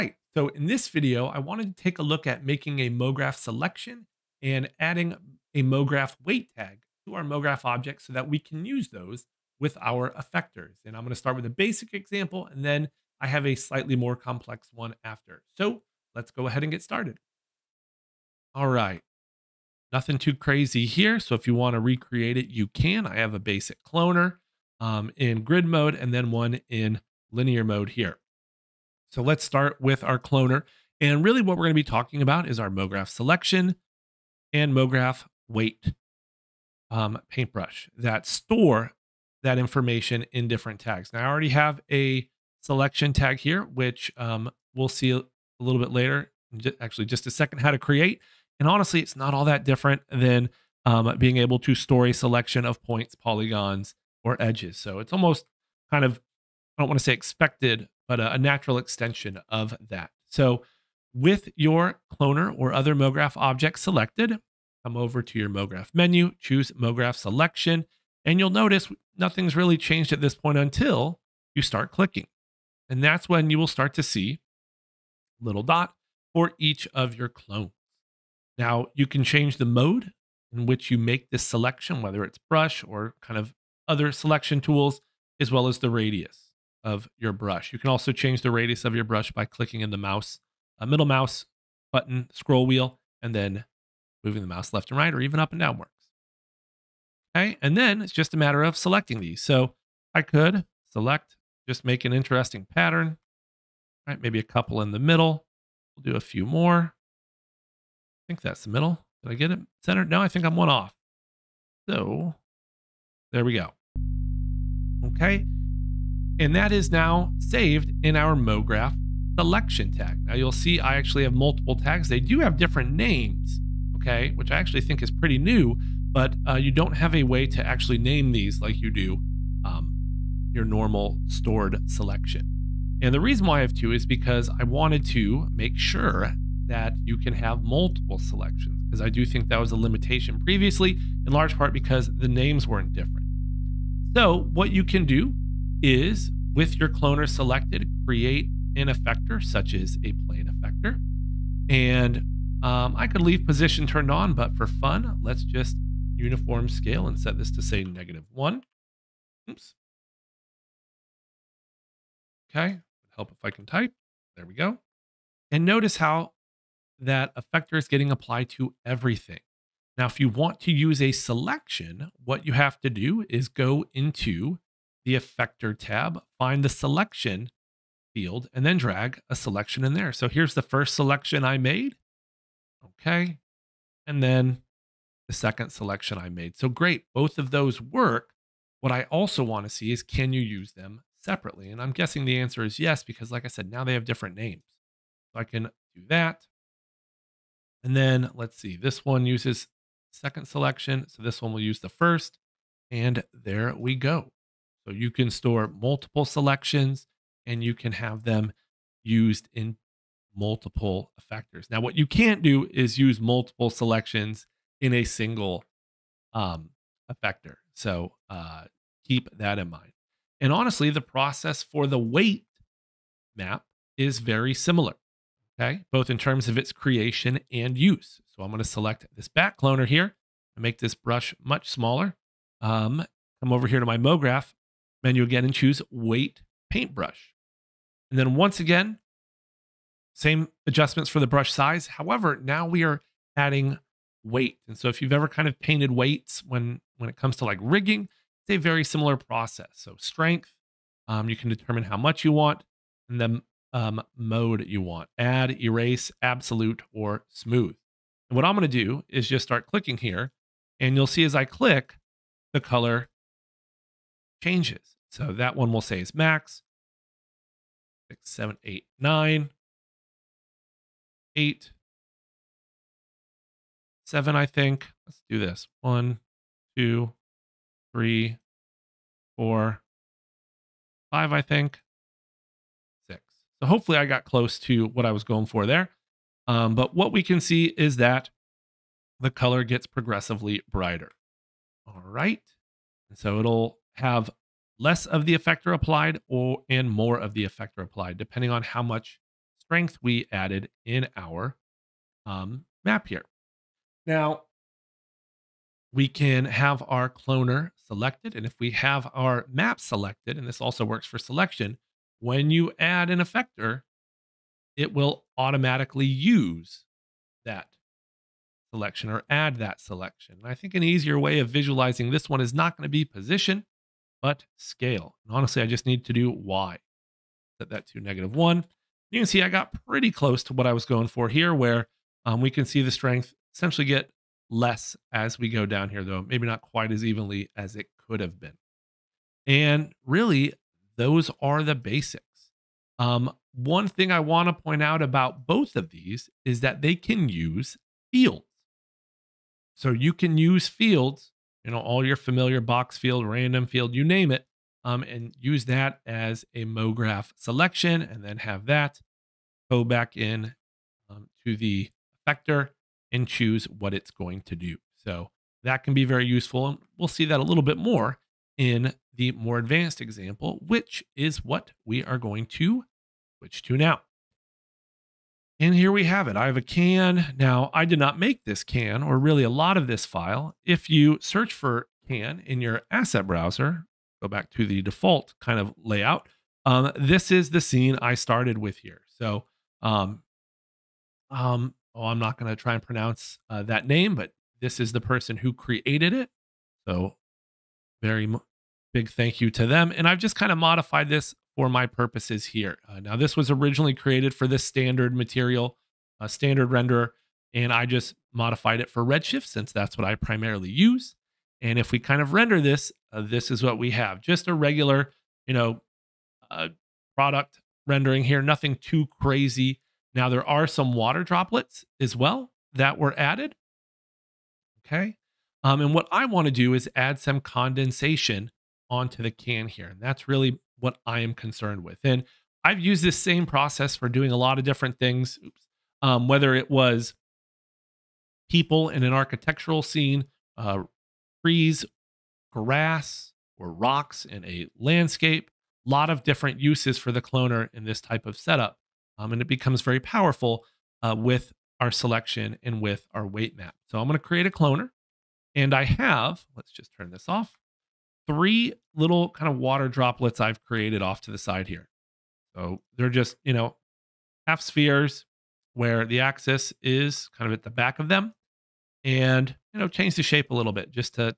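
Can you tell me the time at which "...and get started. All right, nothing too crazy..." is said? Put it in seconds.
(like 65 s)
16 s.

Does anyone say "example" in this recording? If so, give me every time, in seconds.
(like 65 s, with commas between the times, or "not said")
11 s, 369 s.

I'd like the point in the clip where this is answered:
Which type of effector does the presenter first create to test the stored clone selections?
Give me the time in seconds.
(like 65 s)
150 s.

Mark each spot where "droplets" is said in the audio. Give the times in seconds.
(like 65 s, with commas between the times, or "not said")
421 s, 459 s.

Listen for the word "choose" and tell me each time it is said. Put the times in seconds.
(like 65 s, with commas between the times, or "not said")
66 s, 235 s, 363 s.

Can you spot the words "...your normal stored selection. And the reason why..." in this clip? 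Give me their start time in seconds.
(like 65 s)
130 s.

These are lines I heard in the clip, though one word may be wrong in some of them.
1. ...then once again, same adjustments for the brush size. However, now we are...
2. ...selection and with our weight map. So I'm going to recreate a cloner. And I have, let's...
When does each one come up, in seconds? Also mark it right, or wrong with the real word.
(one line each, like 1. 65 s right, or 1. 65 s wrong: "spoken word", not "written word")
1. 238 s right
2. 451 s wrong: "create", not "recreate".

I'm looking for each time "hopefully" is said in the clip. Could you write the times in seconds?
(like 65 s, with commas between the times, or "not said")
283 s.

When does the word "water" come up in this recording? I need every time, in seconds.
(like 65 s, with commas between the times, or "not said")
420 s, 459 s.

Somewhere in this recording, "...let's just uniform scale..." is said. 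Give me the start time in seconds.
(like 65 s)
155 s.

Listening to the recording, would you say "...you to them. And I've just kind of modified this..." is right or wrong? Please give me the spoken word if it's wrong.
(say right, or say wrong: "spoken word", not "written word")
right.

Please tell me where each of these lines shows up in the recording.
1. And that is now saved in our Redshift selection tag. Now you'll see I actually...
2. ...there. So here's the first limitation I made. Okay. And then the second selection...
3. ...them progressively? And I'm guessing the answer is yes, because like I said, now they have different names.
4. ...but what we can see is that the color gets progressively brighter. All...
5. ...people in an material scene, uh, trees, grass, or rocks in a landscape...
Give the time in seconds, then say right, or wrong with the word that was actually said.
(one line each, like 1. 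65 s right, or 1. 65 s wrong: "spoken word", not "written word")
1. 116 s wrong: "MoGraph", not "Redshift"
2. 179 s wrong: "selection", not "limitation"
3. 190 s wrong: "separately", not "progressively"
4. 286 s right
5. 438 s wrong: "architectural", not "material".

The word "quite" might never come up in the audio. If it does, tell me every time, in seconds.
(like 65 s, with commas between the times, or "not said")
336 s.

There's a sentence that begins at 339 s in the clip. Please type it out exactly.
And really, those are the basics.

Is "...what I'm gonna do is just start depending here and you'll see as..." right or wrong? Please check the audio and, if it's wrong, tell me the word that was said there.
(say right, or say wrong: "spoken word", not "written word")
wrong: "clicking", not "depending".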